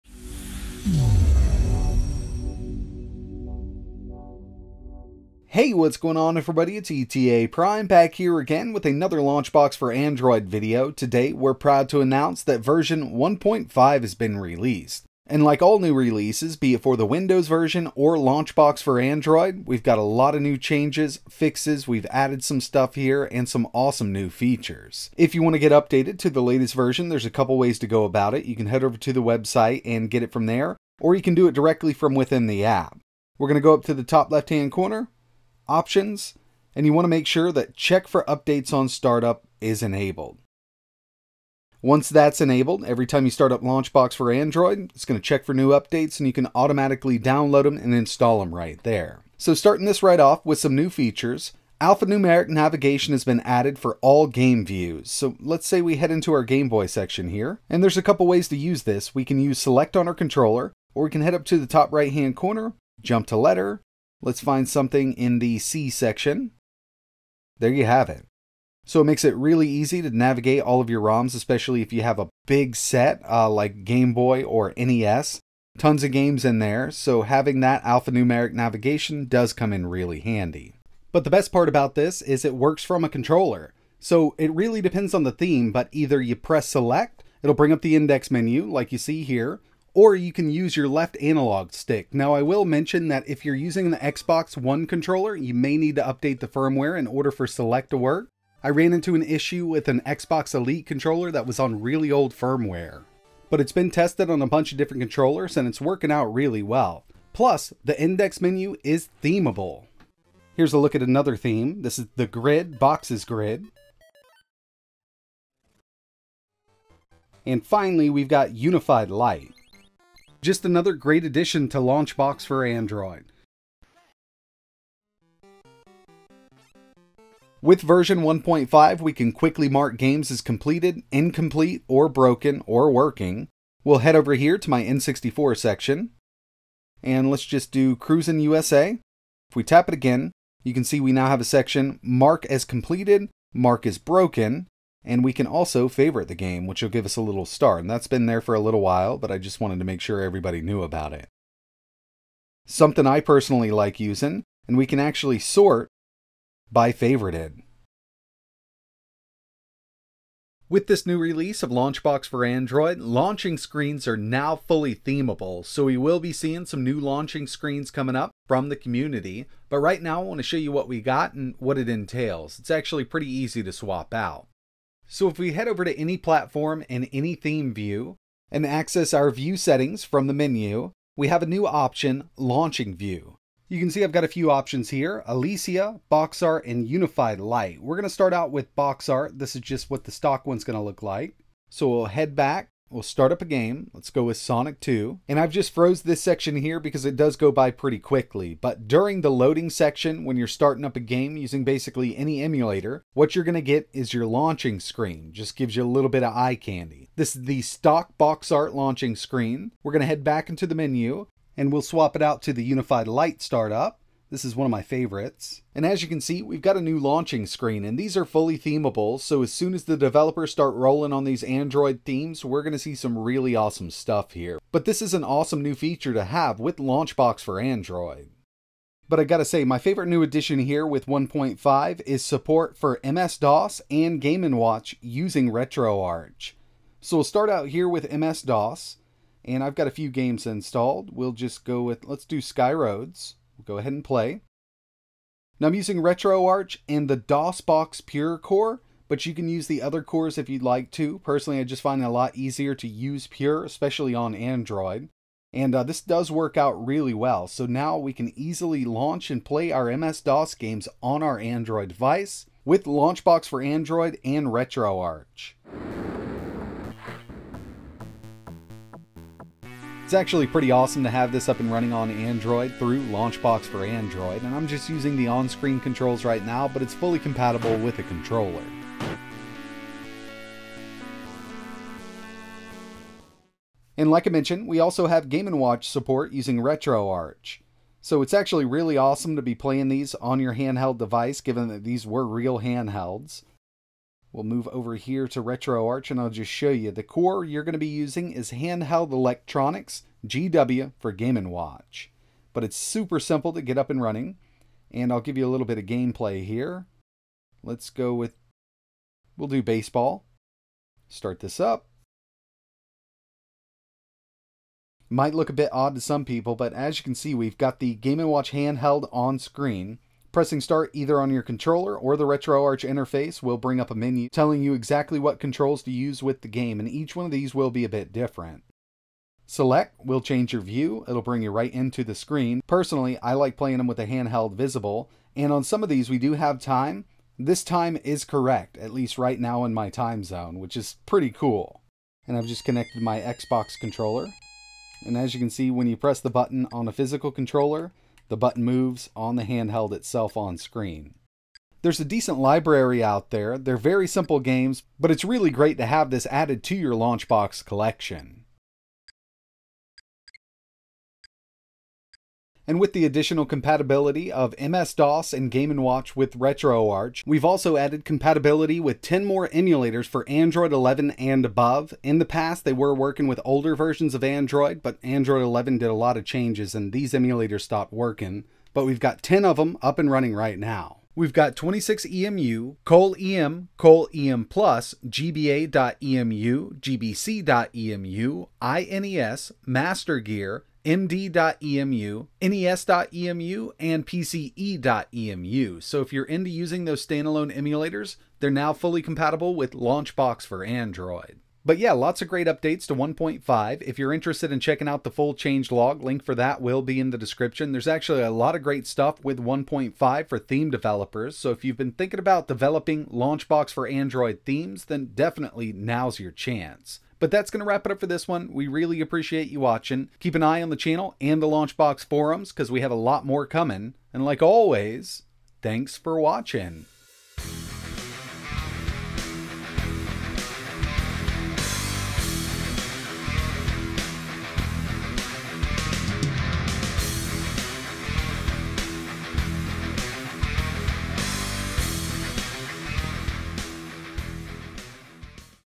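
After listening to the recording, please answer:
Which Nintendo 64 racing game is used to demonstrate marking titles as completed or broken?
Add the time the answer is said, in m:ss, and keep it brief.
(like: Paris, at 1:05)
Cruisin' USA, at 2:17.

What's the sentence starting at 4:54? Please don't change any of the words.
We'll move over here to RetroArch and I'll just show you.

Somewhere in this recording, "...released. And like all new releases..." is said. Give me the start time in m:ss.
0:14.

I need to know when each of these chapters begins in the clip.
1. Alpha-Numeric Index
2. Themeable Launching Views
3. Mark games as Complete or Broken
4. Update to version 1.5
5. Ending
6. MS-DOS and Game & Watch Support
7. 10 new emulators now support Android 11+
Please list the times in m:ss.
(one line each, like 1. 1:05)
1. 0:49
2. 2:40
3. 2:07
4. 0:25
5. 6:41
6. 3:49
7. 6:02.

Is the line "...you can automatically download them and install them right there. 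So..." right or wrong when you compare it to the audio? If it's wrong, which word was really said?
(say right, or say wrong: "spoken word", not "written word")
right.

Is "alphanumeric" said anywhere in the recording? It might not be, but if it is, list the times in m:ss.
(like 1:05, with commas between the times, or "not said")
0:51, 1:17.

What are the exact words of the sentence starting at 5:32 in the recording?
Personally, I like playing them with the handheld visible, and on some of these we do have time.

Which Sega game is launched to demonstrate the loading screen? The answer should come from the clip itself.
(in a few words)
Sonic 2.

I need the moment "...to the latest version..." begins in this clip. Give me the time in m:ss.
0:26.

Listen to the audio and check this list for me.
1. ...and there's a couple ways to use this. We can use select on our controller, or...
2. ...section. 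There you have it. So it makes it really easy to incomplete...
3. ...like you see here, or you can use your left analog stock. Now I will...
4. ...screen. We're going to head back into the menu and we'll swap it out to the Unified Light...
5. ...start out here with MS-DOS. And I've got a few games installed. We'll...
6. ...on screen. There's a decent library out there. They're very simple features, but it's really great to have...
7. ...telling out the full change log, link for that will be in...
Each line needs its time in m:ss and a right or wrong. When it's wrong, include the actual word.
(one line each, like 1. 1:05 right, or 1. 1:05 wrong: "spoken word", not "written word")
1. 0:57 right
2. 1:05 wrong: "navigate", not "incomplete"
3. 1:28 wrong: "stick", not "stock"
4. 3:29 right
5. 3:57 right
6. 5:50 wrong: "games", not "features"
7. 6:44 wrong: "checking", not "telling".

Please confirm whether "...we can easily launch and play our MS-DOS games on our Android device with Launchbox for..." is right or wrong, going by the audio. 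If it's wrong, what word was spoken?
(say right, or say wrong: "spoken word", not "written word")
right.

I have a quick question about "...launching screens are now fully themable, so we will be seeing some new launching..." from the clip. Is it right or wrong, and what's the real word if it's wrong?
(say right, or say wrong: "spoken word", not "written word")
right.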